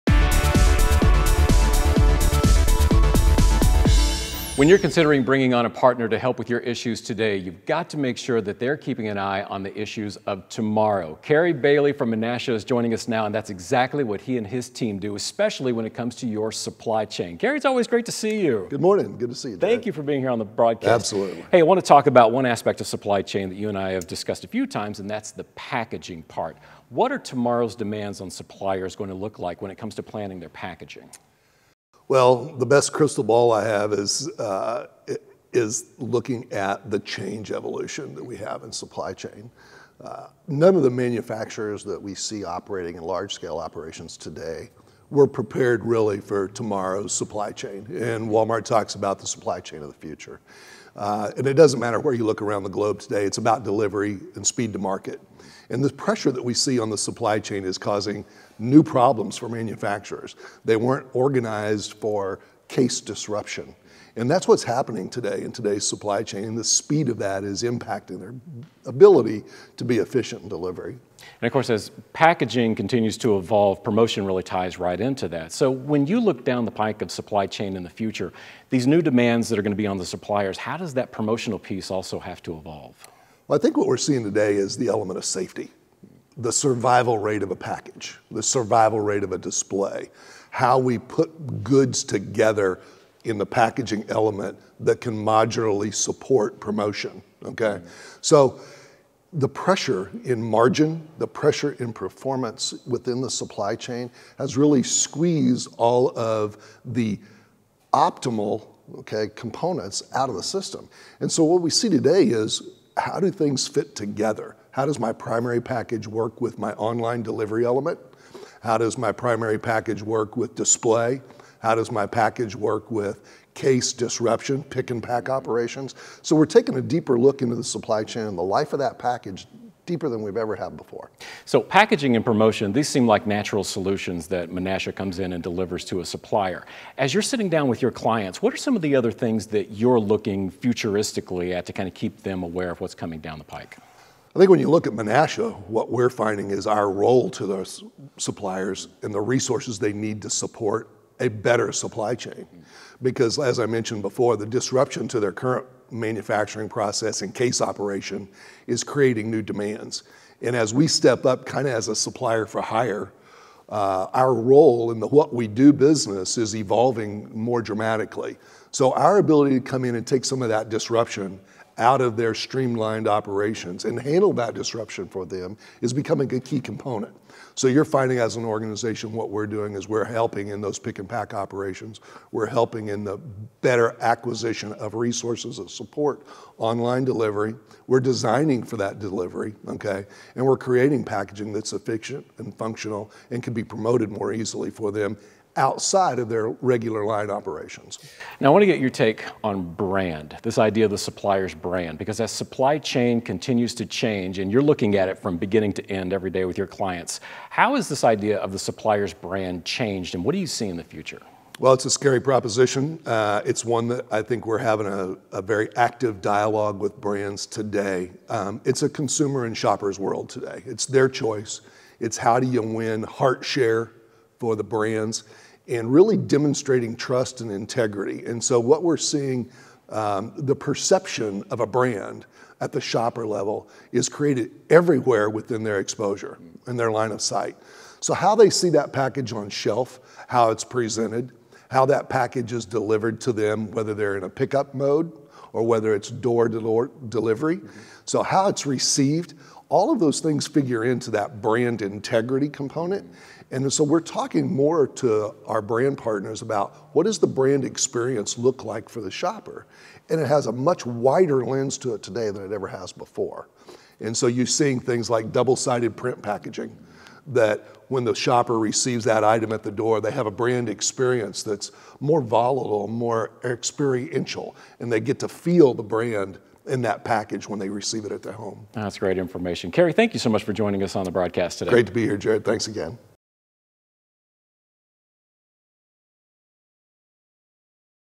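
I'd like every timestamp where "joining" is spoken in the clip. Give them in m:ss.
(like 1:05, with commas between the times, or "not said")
0:12, 4:40.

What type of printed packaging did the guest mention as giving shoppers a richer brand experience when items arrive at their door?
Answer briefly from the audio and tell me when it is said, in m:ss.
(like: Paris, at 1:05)
Double-sided print packaging, at 4:25.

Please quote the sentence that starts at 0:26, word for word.
What are tomorrow's demands on suppliers going to look like when it comes to planning their packaging?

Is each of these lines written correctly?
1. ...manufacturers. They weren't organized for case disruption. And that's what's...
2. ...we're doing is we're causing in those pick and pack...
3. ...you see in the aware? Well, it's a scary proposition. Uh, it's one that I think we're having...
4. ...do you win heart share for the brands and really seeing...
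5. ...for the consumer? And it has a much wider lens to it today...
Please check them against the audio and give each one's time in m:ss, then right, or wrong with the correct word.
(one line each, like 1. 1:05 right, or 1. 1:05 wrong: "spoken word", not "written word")
1. 0:59 right
2. 2:59 wrong: "helping", not "causing"
3. 3:30 wrong: "future", not "aware"
4. 3:42 wrong: "demonstrating", not "seeing"
5. 4:18 wrong: "shopper", not "consumer".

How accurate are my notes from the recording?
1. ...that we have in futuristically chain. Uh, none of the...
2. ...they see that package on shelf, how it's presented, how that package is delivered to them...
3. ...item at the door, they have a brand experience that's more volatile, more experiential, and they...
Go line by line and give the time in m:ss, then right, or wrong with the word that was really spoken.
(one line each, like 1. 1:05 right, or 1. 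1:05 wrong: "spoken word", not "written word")
1. 0:38 wrong: "supply", not "futuristically"
2. 3:58 right
3. 4:29 right.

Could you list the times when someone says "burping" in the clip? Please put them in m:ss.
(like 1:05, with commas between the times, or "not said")
not said.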